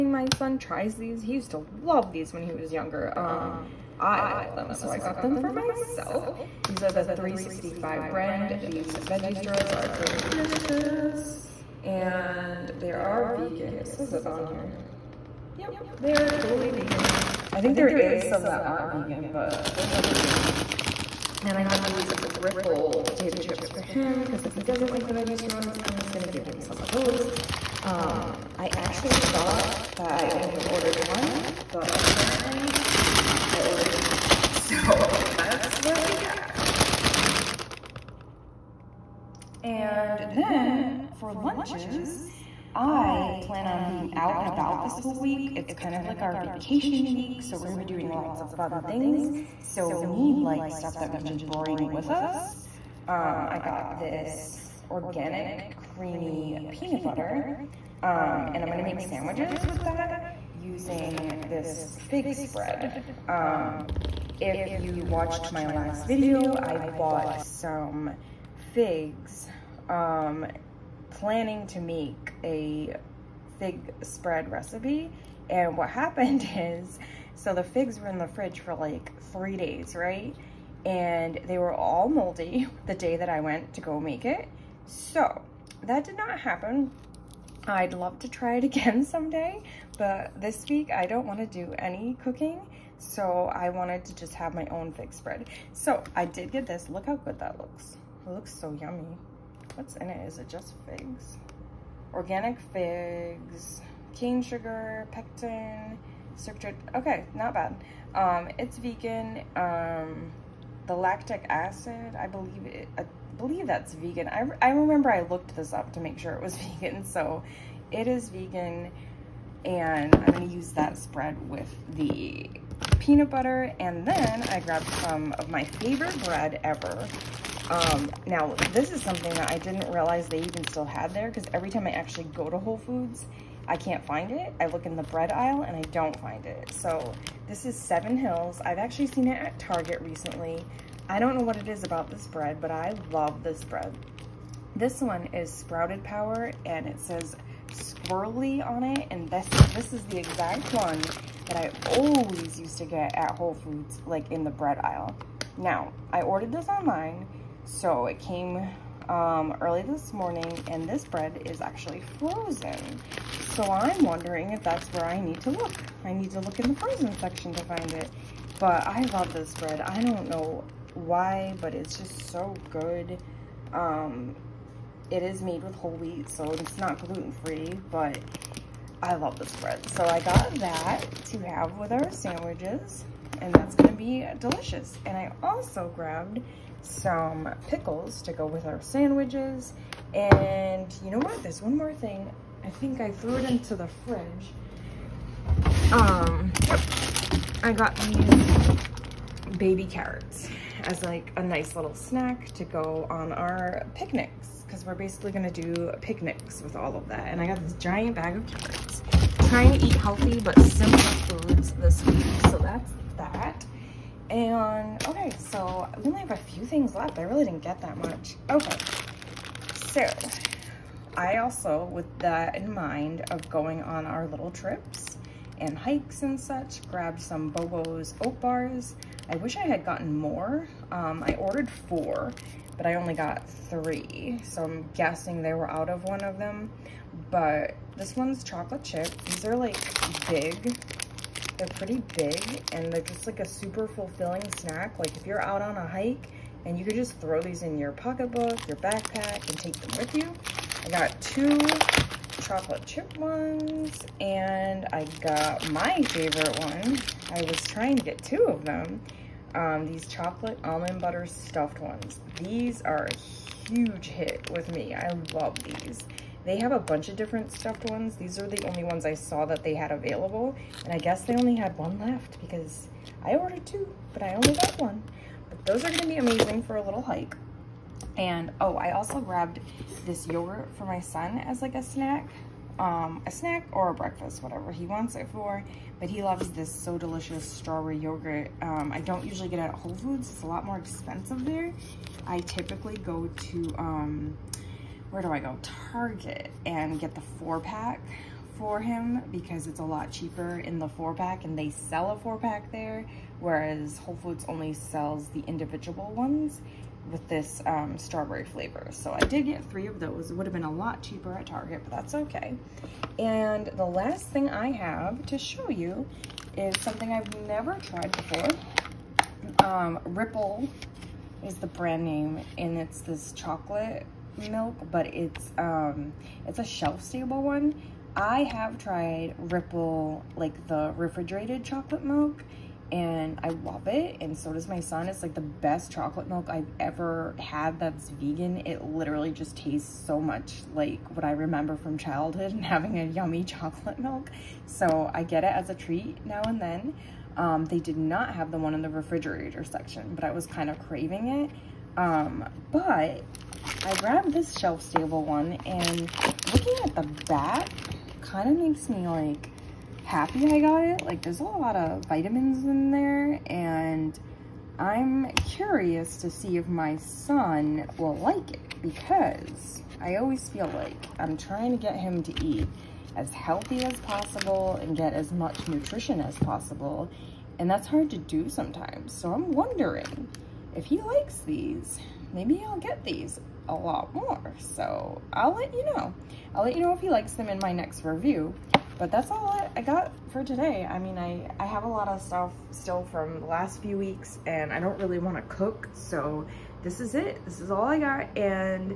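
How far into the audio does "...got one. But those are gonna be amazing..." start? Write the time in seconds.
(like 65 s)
274 s.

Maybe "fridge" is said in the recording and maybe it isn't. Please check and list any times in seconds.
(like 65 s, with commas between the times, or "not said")
78 s, 194 s.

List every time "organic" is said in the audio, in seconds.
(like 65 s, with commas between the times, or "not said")
54 s, 102 s.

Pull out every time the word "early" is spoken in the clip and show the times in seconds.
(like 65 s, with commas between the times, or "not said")
159 s.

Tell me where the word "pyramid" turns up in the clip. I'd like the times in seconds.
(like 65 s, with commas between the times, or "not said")
not said.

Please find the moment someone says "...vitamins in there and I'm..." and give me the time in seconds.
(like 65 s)
362 s.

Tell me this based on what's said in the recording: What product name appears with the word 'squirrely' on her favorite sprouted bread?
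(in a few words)
Sprouted Power.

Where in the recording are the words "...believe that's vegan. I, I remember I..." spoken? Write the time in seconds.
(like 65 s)
113 s.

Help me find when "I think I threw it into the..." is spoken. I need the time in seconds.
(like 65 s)
192 s.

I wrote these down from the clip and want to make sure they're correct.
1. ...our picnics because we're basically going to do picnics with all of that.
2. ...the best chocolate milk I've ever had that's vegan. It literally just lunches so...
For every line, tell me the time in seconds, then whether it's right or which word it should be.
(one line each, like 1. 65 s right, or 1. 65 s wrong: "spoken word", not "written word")
1. 203 s right
2. 335 s wrong: "tastes", not "lunches".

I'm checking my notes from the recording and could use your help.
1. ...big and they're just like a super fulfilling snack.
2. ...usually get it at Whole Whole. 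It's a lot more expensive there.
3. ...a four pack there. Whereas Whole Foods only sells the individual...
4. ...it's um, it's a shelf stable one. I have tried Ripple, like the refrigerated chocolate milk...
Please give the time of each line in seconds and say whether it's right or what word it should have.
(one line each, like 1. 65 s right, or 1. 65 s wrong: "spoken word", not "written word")
1. 242 s right
2. 289 s wrong: "Foods", not "Whole"
3. 302 s right
4. 325 s right.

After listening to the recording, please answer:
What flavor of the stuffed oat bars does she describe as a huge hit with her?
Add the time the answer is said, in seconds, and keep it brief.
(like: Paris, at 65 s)
Chocolate almond butter, at 260 s.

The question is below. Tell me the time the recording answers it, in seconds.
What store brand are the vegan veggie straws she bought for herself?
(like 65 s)
7 s.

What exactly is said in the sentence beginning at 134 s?
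I look in the bread aisle and I don't find it.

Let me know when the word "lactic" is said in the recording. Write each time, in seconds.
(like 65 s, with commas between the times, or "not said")
110 s.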